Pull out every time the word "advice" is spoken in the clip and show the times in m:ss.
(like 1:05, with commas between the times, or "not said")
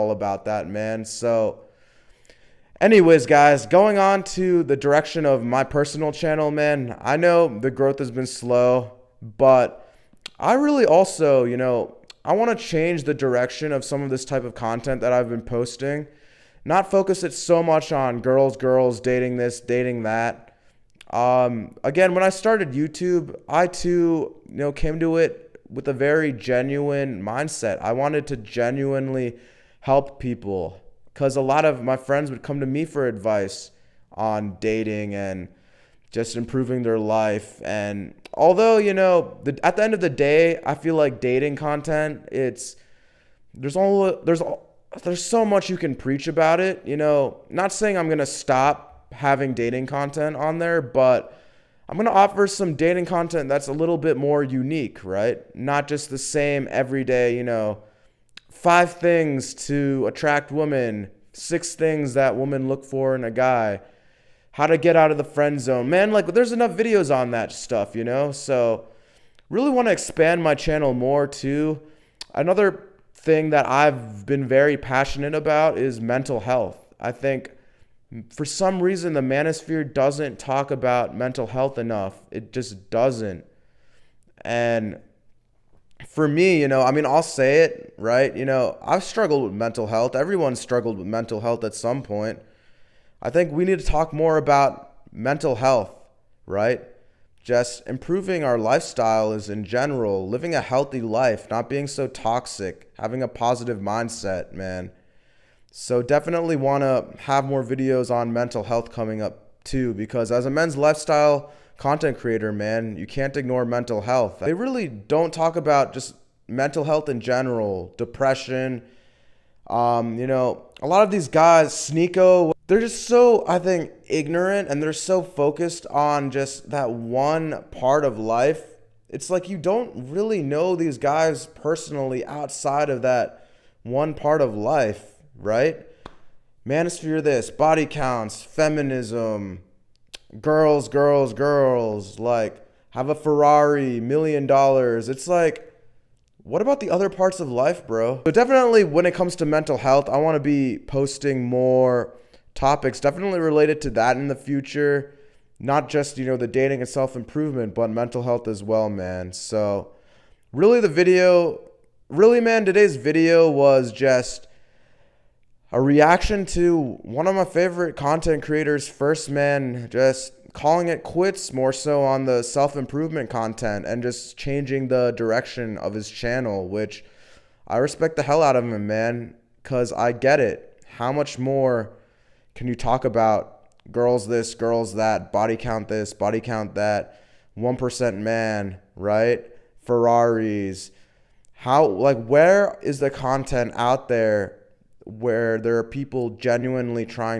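0:33.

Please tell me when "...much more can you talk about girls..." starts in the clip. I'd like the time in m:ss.
3:01.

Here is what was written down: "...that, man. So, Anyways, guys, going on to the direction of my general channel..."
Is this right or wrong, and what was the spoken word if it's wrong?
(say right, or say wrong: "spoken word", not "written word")
wrong: "personal", not "general".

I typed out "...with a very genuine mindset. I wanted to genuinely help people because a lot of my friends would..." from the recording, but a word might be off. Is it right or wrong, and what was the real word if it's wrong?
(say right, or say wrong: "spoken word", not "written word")
right.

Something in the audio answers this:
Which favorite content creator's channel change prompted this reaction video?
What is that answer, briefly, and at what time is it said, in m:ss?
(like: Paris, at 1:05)
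First Man, at 2:48.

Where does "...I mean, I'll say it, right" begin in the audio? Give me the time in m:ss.
1:26.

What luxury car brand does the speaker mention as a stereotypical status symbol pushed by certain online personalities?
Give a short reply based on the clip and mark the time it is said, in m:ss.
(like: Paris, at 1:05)
Ferrari, at 2:23.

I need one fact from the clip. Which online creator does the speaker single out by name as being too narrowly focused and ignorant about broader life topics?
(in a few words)
Sneako.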